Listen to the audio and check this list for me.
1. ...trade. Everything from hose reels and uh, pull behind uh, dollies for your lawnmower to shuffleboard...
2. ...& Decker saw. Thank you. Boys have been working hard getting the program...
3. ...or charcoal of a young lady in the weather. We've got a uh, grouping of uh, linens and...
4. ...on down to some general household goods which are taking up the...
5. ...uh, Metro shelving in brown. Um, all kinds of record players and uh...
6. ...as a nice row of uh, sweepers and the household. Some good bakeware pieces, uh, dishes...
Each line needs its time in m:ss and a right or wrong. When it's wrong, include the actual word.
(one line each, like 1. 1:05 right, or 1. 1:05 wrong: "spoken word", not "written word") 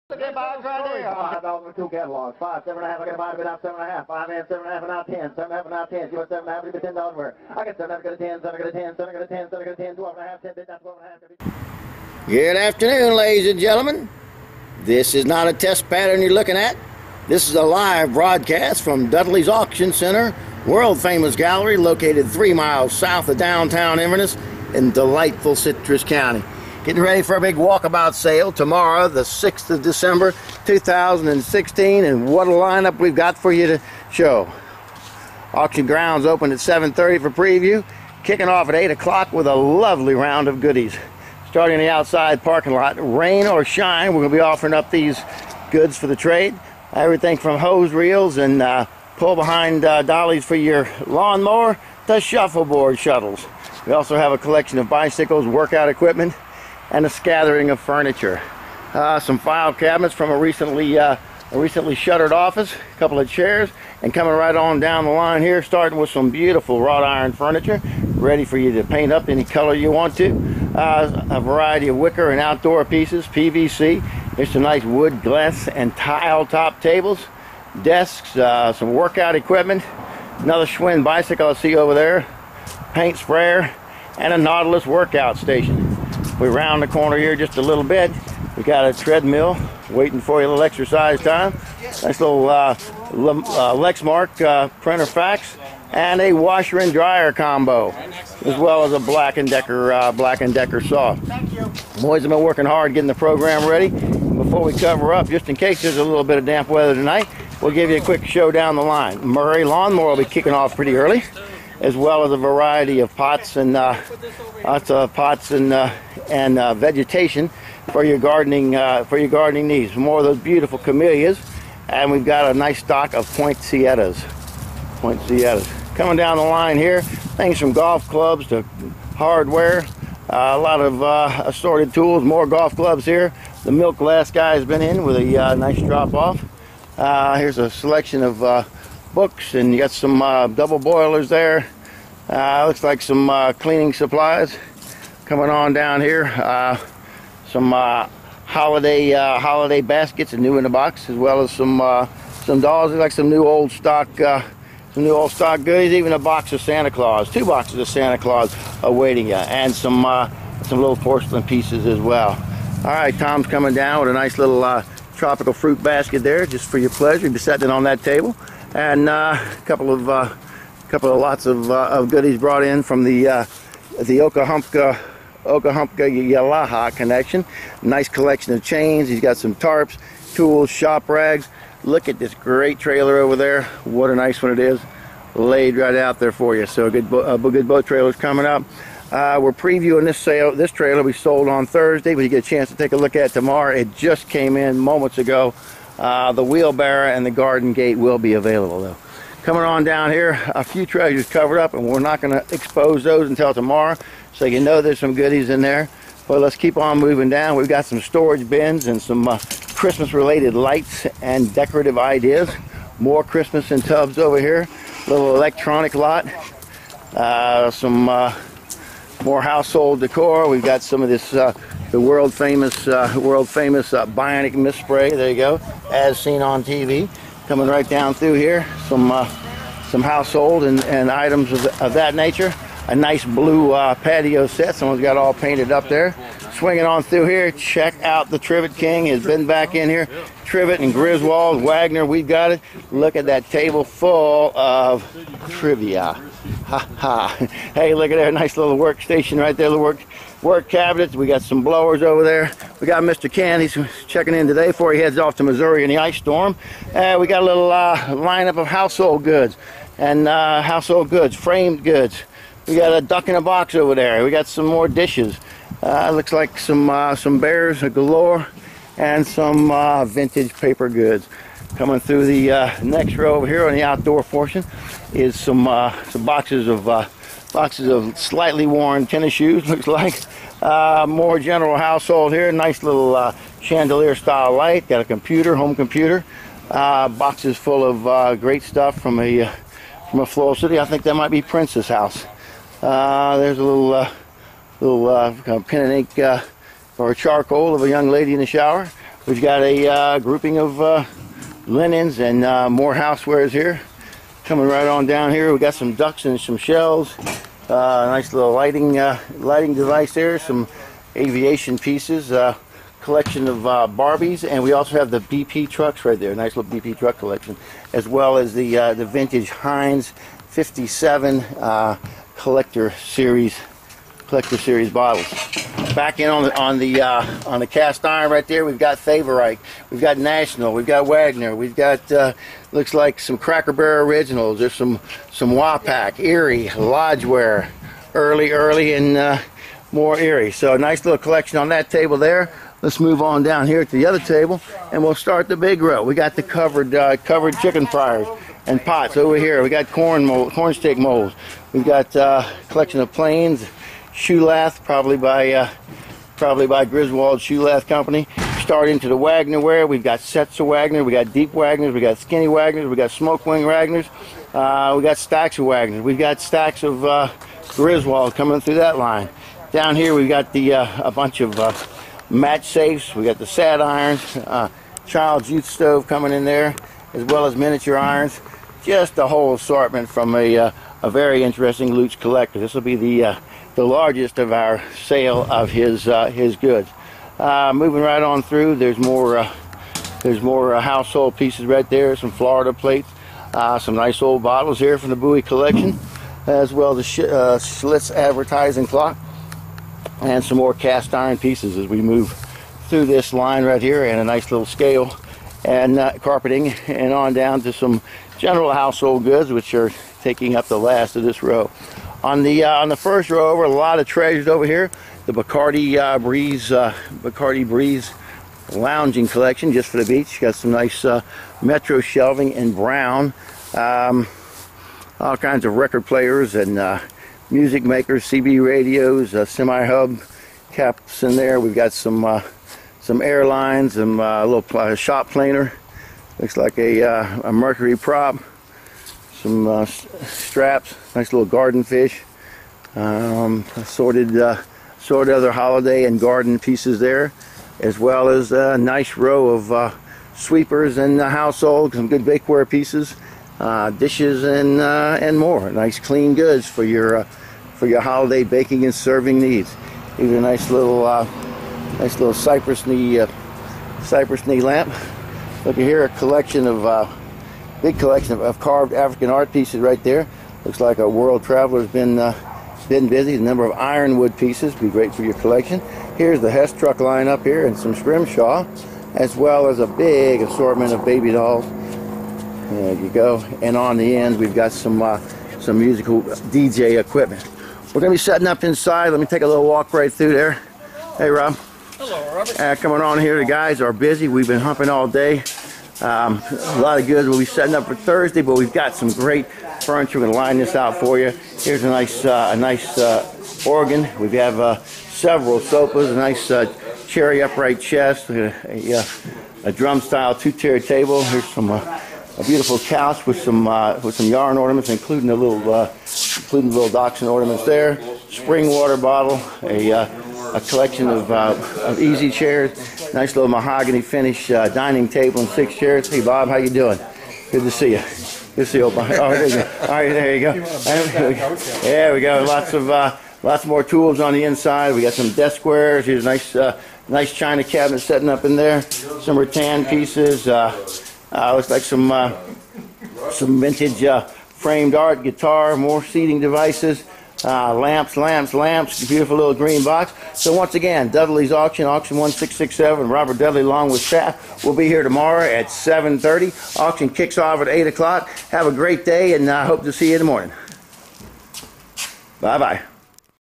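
1. 0:46 right
2. 1:40 right
3. 4:56 wrong: "shower", not "weather"
4. 6:47 right
5. 7:01 right
6. 7:28 right.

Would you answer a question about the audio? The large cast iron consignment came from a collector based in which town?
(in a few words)
Lutz.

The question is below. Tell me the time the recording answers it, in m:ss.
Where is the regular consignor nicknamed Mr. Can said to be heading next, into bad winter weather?
4:15.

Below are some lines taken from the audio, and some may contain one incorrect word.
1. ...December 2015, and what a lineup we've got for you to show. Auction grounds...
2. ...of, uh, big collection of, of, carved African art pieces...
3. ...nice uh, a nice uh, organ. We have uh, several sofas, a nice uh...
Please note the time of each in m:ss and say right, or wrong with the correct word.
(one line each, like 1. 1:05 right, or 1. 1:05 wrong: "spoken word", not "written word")
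1. 0:29 wrong: "2016", not "2015"
2. 7:46 right
3. 8:21 right.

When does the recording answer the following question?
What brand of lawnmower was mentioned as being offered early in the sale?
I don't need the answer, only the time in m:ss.
1:49.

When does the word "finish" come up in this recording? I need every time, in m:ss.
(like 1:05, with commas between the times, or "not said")
8:44.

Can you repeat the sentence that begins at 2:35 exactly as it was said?
Even a box of Santa Claus, two boxes of Santa Claus awaiting you, and some some little porcelain pieces as well.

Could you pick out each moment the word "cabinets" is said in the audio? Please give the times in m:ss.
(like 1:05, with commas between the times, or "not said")
0:59, 4:10, 8:57.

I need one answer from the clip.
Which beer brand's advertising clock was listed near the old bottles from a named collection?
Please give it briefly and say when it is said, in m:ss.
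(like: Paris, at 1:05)
Schlitz, at 6:37.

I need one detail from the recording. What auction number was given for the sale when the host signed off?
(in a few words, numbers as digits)
1667.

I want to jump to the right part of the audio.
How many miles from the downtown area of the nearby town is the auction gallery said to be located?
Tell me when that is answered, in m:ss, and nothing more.
0:22.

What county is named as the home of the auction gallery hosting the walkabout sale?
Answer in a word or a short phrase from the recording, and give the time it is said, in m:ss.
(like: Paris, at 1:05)
Citrus County, at 0:25.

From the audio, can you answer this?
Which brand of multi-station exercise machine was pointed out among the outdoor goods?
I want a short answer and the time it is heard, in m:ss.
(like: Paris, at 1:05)
Nautilus, at 1:24.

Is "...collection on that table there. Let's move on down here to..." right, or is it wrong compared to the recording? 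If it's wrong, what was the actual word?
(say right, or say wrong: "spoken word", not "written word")
right.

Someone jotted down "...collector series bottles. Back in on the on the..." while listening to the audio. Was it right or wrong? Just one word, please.
right.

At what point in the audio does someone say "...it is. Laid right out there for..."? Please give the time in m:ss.
3:04.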